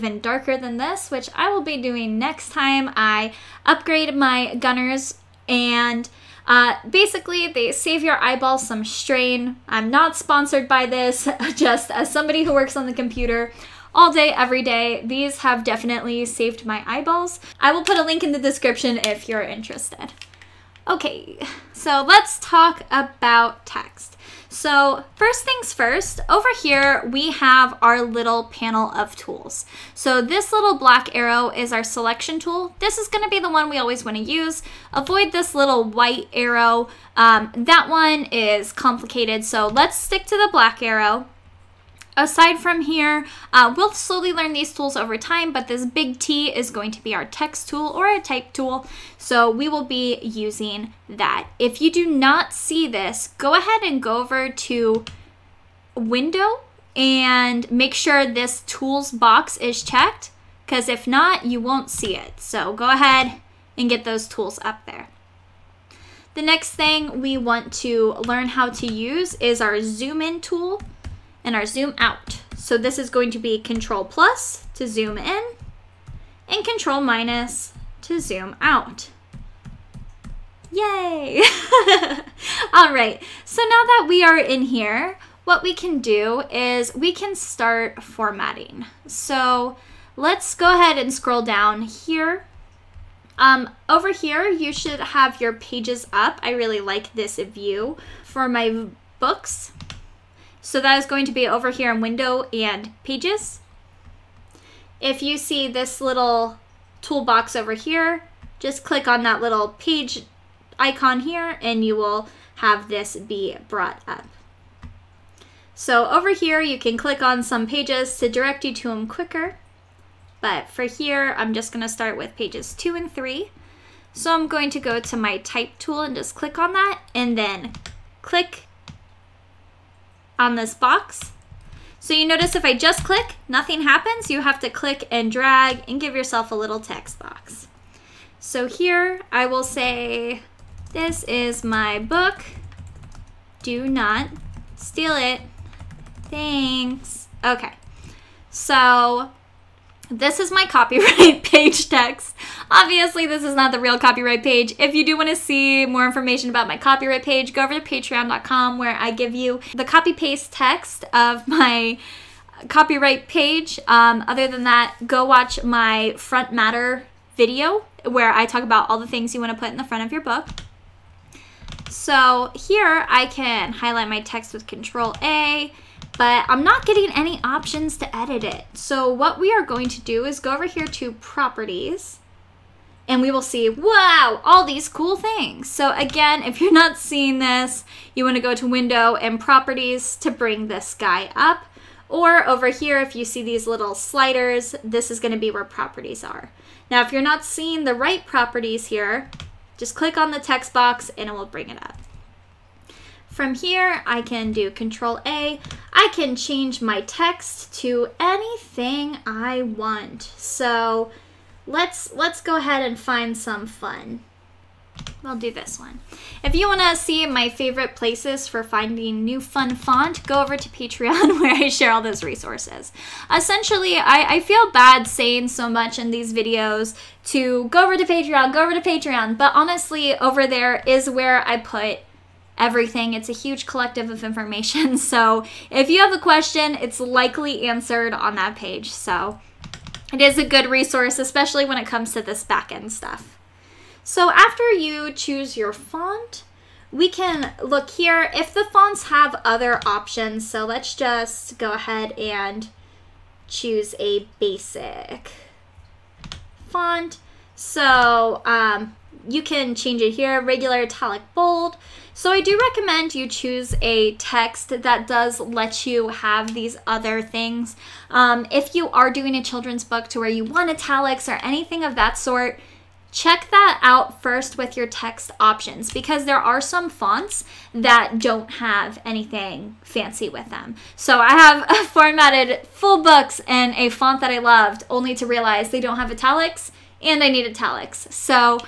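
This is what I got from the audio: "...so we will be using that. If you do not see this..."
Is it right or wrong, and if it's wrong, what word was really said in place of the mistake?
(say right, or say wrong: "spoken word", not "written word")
right.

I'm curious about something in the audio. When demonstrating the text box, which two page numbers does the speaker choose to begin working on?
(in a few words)
2 and 3.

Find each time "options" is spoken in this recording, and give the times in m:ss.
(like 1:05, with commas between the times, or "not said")
2:57, 4:09, 4:35.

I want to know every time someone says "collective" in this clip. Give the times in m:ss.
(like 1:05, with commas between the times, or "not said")
3:53.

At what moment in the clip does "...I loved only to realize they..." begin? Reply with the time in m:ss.
4:44.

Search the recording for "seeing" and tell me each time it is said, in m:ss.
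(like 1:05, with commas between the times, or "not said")
3:06, 3:17.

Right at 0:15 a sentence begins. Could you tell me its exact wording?
These have definitely saved my eyeballs.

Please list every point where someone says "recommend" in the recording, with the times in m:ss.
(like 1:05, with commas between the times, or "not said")
4:22.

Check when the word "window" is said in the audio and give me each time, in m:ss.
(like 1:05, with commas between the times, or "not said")
0:55, 1:42, 3:08.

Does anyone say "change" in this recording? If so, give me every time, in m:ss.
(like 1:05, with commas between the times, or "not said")
3:26, 4:19.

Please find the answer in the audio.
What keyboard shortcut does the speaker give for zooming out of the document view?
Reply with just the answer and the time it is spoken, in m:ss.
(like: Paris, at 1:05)
Control minus, at 1:16.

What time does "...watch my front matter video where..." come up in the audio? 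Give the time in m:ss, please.
2:45.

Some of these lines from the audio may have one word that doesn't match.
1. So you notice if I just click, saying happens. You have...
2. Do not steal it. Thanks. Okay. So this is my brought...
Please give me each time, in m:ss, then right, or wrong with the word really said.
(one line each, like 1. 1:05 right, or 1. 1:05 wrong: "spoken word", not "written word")
1. 2:11 wrong: "nothing", not "saying"
2. 2:23 wrong: "copyright", not "brought".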